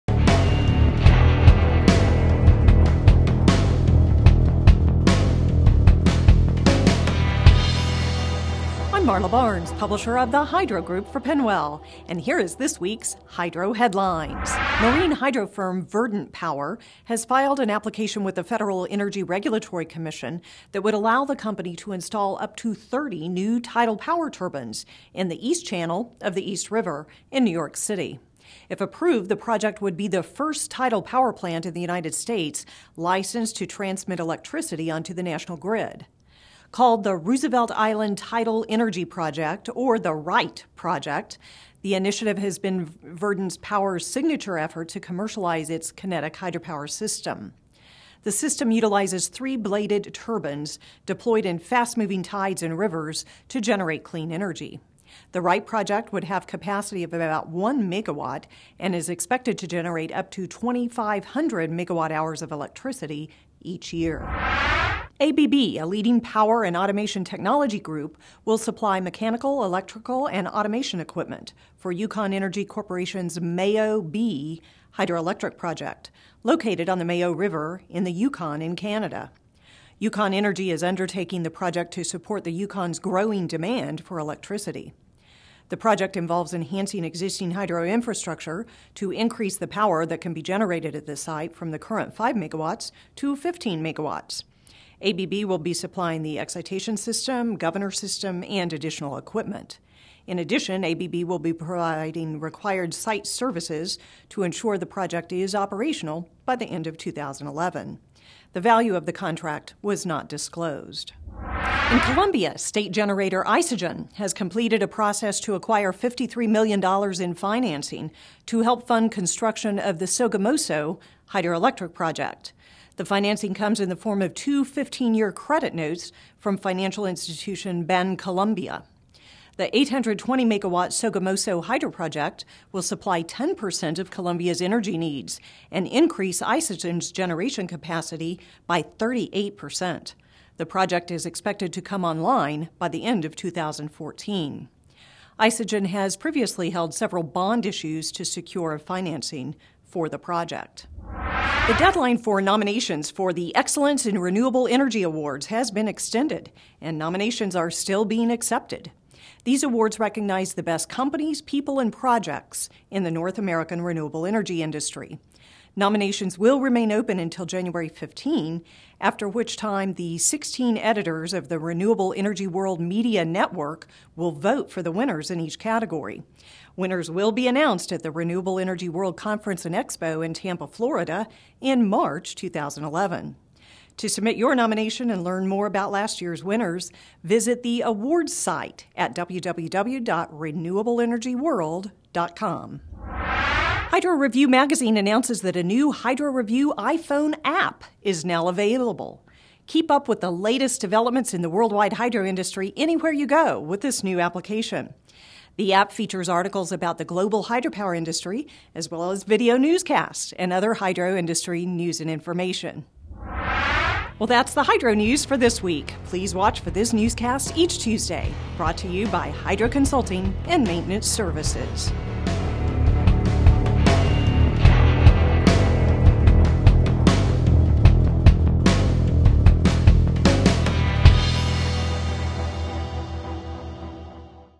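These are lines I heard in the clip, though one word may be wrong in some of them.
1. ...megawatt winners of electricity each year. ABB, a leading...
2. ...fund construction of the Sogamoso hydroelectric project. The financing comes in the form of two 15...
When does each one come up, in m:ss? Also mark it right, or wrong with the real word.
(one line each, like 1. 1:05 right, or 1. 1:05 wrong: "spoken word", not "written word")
1. 1:01 wrong: "hours", not "winners"
2. 1:58 right.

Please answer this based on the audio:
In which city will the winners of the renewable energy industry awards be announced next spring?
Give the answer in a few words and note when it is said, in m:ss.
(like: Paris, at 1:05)
Tampa, at 3:00.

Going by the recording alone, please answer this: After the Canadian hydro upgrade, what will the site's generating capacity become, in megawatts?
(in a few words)
15 megawatts.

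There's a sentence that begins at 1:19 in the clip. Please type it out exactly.
Yukon Energy is undertaking the project to support the Yukon's growing demand for electricity.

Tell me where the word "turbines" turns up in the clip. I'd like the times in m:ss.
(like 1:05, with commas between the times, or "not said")
0:24, 0:50.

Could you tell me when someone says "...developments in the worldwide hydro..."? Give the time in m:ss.
3:20.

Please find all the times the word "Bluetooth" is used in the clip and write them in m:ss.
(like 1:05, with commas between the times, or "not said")
not said.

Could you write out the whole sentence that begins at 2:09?
The 820 megawatt Sogamoso hydro project will supply 10% of Colombia's energy needs and increase Isagen's generation capacity by 38%.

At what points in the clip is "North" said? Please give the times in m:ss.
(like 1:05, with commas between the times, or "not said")
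2:43.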